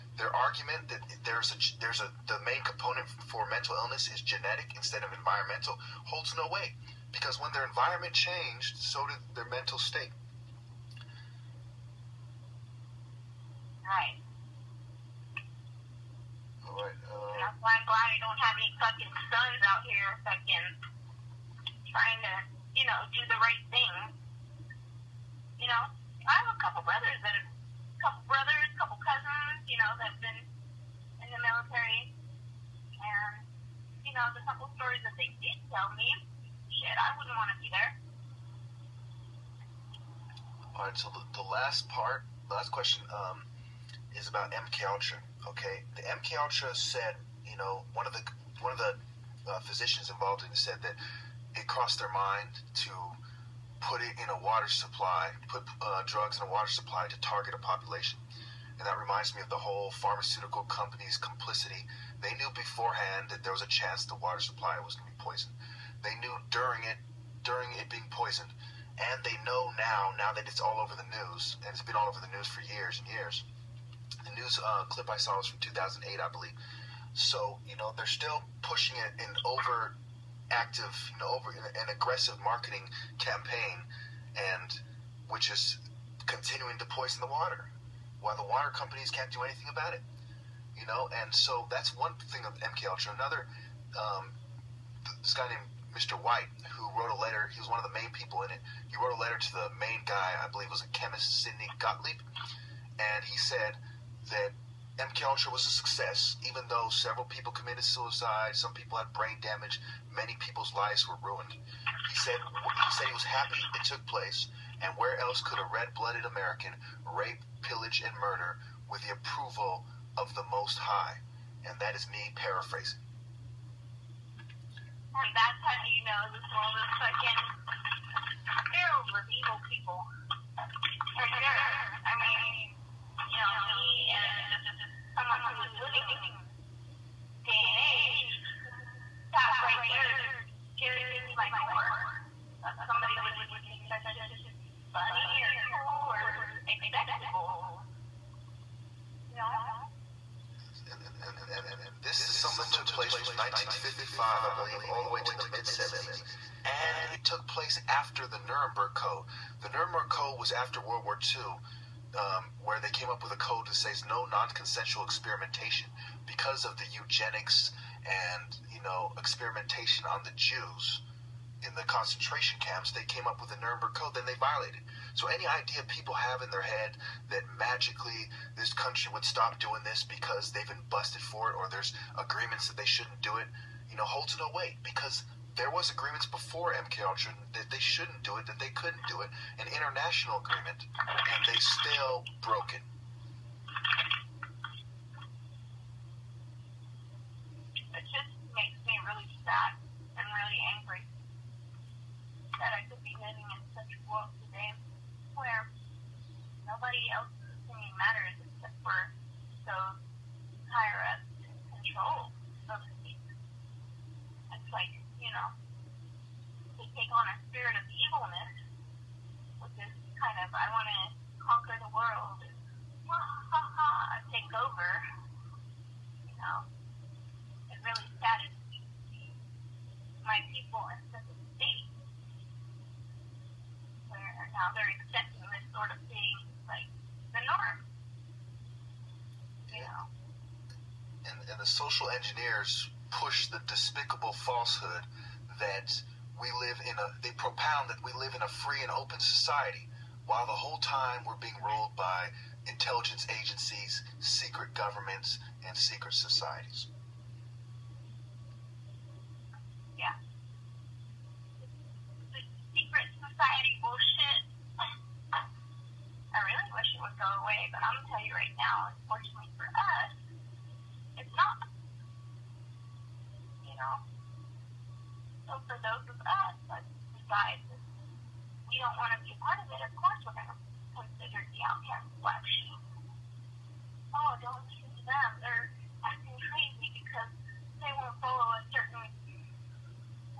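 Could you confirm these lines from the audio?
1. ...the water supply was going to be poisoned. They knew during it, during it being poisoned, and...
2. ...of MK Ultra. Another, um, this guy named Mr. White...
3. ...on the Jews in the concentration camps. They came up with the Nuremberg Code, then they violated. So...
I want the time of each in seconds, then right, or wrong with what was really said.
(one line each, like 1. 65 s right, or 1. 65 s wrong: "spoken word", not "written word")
1. 64 s right
2. 92 s right
3. 170 s right.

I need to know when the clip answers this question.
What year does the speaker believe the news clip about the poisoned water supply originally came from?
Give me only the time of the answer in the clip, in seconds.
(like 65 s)
75 s.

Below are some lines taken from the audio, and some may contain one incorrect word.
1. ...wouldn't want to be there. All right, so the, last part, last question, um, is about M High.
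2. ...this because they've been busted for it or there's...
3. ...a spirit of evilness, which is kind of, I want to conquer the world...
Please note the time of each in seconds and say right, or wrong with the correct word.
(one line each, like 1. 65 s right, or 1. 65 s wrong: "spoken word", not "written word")
1. 37 s wrong: "Ultra", not "High"
2. 179 s right
3. 217 s right.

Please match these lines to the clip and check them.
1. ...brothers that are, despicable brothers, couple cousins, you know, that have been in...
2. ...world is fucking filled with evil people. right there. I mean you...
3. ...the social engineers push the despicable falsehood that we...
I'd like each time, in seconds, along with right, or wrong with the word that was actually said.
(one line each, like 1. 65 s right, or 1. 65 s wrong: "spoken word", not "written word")
1. 26 s wrong: "couple", not "despicable"
2. 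126 s right
3. 241 s right.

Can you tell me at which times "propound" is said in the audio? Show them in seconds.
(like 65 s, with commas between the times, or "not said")
247 s.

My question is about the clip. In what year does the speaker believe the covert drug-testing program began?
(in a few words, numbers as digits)
1955.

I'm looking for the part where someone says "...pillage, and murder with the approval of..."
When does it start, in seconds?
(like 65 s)
117 s.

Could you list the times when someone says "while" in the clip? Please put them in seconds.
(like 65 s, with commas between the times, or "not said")
88 s, 250 s.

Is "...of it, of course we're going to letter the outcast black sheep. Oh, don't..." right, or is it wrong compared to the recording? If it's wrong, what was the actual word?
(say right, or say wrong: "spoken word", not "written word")
wrong: "consider", not "letter".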